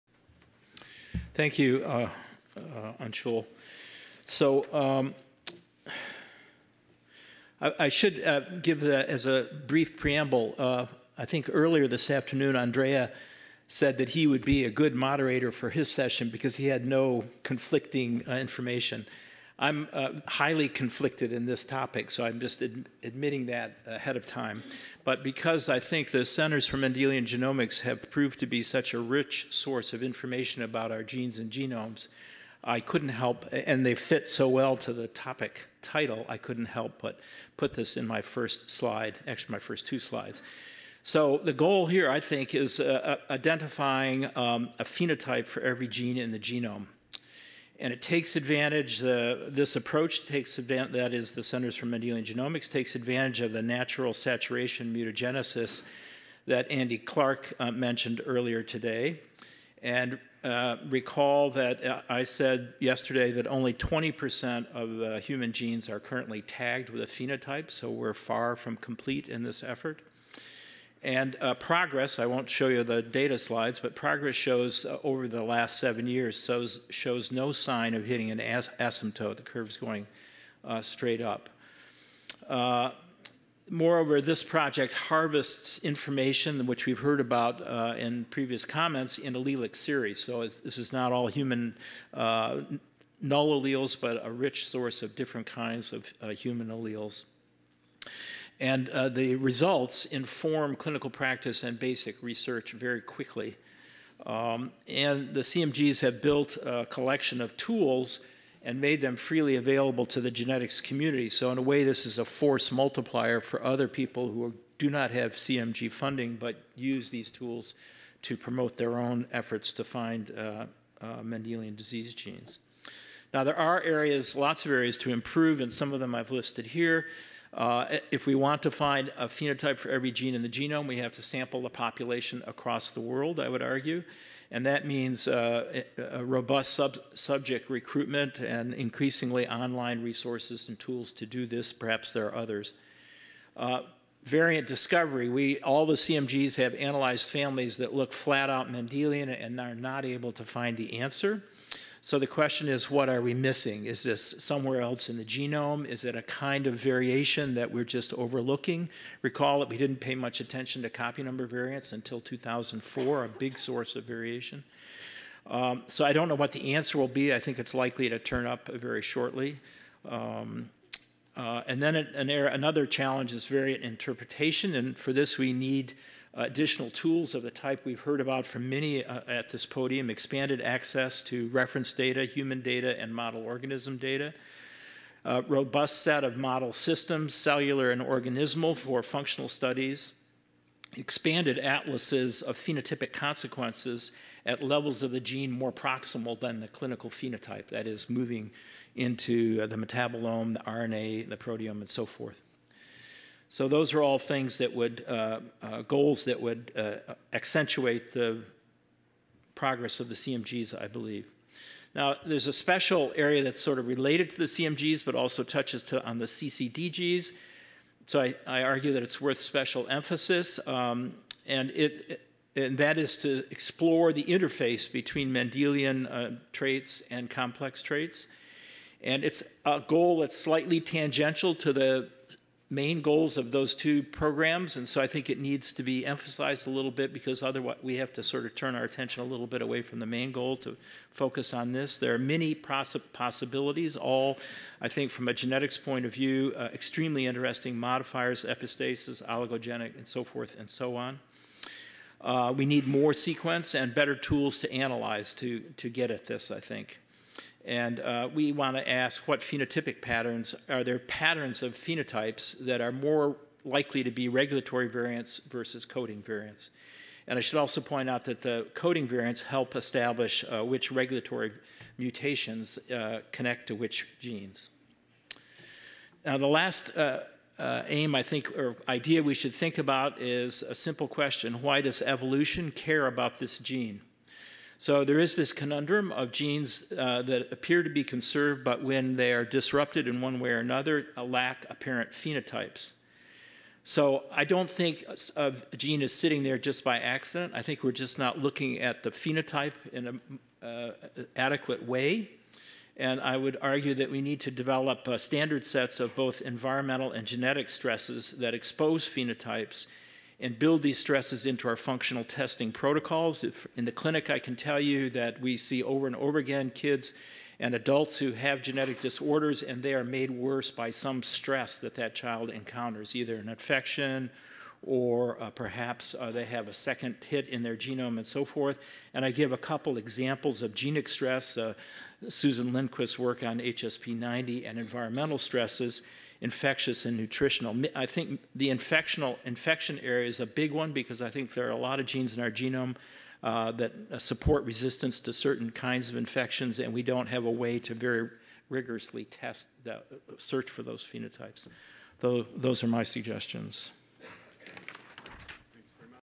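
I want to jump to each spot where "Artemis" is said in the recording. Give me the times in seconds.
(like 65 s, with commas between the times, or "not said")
not said.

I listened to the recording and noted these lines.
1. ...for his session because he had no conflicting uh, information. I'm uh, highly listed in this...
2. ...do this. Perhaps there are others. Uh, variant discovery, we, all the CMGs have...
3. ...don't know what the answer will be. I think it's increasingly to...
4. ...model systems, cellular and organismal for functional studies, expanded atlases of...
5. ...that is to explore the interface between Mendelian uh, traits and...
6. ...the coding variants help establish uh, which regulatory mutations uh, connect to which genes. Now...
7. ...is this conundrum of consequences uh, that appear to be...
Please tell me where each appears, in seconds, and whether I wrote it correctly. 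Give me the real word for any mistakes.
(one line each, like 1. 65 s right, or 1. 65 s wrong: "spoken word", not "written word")
1. 15 s wrong: "conflicted", not "listed"
2. 141 s right
3. 166 s wrong: "likely", not "increasingly"
4. 186 s right
5. 222 s right
6. 268 s right
7. 285 s wrong: "genes", not "consequences".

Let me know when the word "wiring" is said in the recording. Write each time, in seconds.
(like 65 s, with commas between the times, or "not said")
not said.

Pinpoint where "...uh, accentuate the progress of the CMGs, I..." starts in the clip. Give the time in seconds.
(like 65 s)
206 s.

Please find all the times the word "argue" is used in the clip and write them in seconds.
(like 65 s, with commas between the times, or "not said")
133 s, 218 s, 303 s.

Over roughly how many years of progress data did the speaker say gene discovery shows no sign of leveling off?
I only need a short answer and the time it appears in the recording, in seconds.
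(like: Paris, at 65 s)
7, at 75 s.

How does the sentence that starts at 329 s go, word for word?
And I give a couple examples of genic stress, uh, Susan Lindquist's work on HSP90 and environmental stresses infectious and nutritional.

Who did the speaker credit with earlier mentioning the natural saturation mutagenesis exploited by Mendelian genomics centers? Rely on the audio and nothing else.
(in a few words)
Andy Clark.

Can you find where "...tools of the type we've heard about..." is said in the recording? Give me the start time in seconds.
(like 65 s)
176 s.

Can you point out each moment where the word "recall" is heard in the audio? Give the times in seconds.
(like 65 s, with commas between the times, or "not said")
60 s, 159 s.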